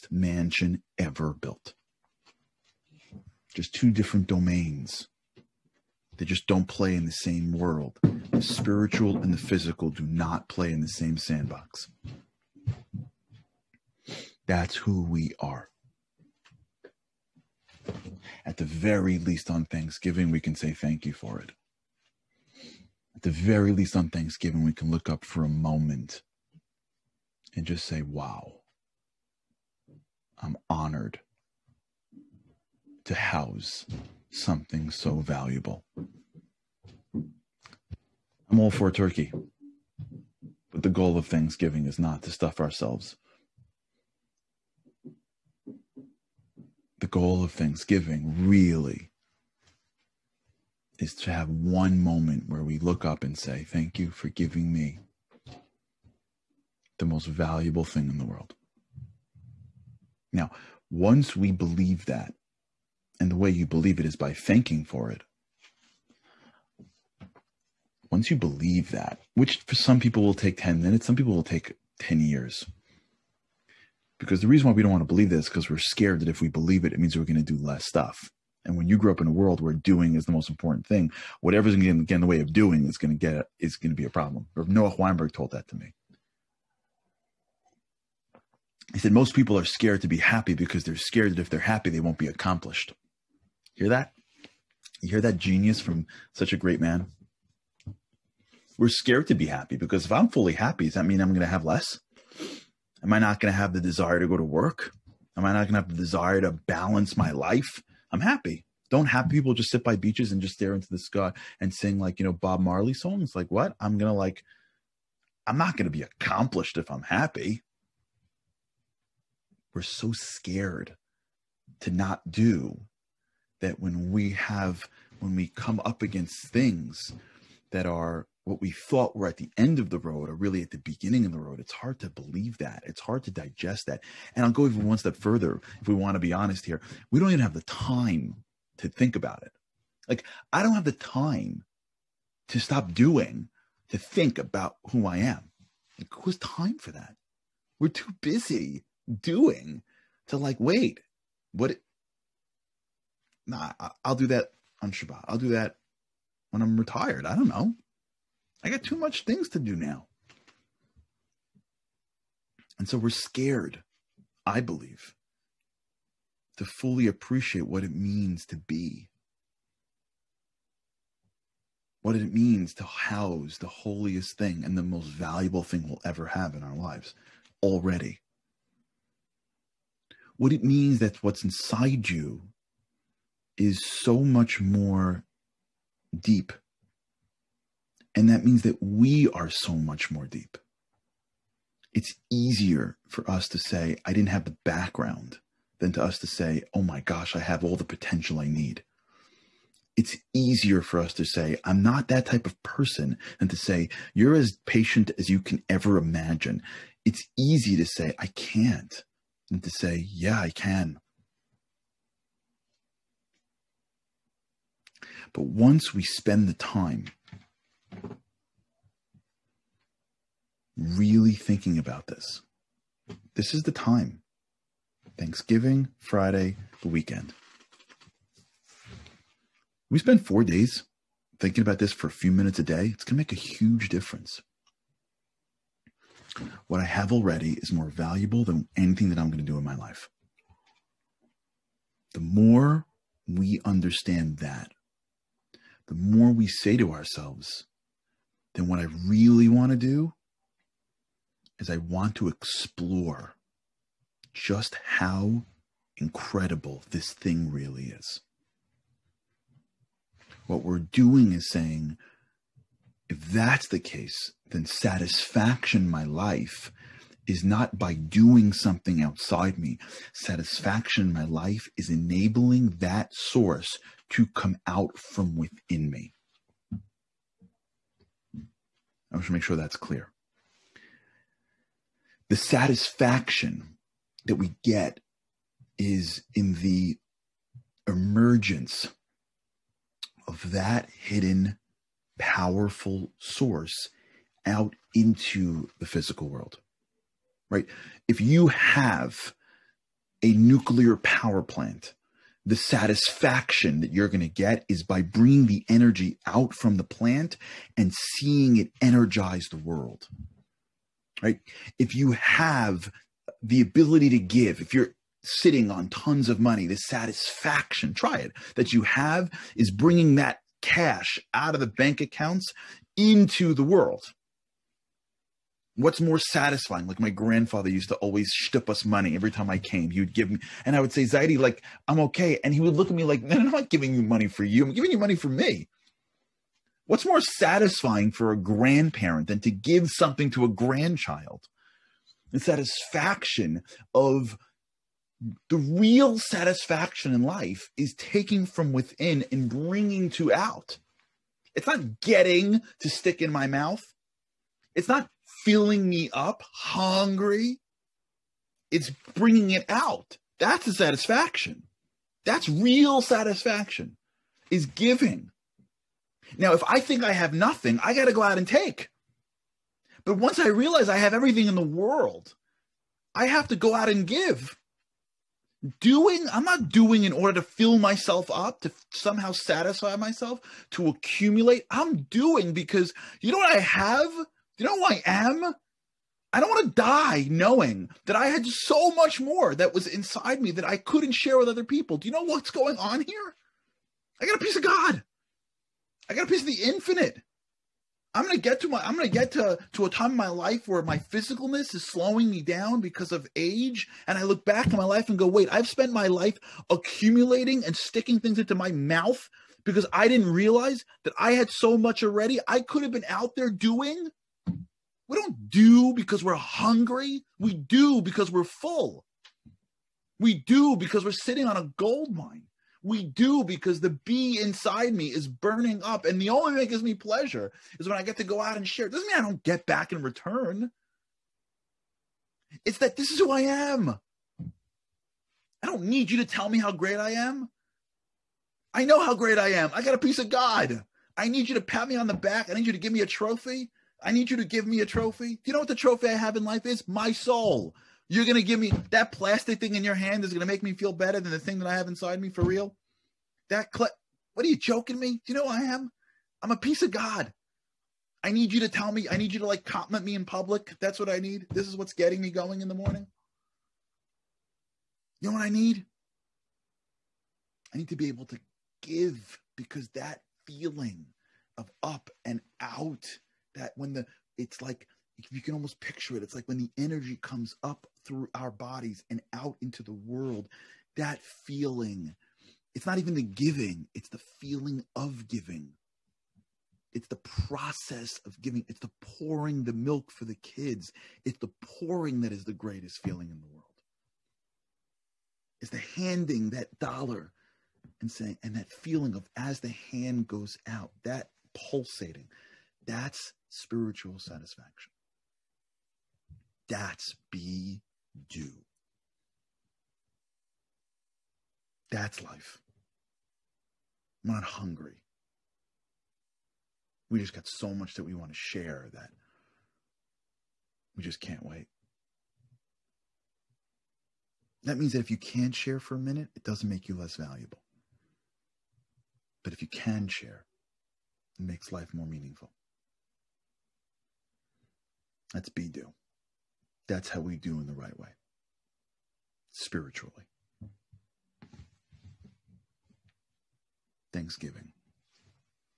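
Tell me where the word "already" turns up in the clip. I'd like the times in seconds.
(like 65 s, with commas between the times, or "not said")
177 s, 237 s, 412 s.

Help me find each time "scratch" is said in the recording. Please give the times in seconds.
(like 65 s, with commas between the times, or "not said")
not said.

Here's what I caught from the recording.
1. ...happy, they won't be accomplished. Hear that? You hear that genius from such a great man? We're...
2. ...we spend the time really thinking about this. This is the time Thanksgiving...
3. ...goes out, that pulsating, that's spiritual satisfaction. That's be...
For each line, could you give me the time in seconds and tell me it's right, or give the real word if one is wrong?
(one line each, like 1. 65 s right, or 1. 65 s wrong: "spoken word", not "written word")
1. 91 s right
2. 215 s right
3. 500 s right.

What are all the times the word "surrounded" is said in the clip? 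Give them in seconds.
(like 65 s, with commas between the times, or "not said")
not said.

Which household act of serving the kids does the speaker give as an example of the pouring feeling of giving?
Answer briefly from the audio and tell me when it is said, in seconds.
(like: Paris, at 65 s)
Pouring the milk, at 488 s.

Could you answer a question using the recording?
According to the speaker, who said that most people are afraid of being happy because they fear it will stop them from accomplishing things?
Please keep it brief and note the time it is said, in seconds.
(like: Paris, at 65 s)
Noah Weinberg, at 84 s.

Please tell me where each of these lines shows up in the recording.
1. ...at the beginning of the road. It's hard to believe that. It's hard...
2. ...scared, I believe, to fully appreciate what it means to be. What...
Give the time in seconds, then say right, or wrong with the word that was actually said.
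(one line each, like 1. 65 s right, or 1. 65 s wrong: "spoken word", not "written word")
1. 130 s right
2. 163 s right.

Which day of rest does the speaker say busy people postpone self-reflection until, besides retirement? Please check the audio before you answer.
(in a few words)
Shabbat.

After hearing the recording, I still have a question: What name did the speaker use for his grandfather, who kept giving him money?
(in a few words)
Zaidi.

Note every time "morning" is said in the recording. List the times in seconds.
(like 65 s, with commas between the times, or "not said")
462 s.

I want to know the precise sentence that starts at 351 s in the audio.
It's not getting to stick in my mouth.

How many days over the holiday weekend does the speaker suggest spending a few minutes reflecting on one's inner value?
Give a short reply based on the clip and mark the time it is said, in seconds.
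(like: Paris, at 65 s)
4, at 230 s.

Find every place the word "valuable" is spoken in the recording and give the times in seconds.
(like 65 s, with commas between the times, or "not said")
35 s, 57 s, 175 s, 237 s, 527 s.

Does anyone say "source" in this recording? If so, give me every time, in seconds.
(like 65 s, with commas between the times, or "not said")
273 s, 293 s.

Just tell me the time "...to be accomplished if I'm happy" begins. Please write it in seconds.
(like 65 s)
115 s.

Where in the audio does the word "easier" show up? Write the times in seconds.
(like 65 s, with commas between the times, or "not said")
192 s, 200 s.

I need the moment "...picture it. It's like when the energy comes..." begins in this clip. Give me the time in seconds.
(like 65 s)
475 s.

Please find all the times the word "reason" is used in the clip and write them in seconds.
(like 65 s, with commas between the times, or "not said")
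74 s.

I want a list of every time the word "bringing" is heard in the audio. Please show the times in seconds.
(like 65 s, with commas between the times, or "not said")
305 s, 319 s, 349 s, 359 s.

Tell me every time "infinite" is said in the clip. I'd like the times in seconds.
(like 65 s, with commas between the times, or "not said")
396 s.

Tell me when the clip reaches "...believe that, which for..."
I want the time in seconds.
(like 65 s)
68 s.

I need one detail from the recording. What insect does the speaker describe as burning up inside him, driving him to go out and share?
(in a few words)
Bee.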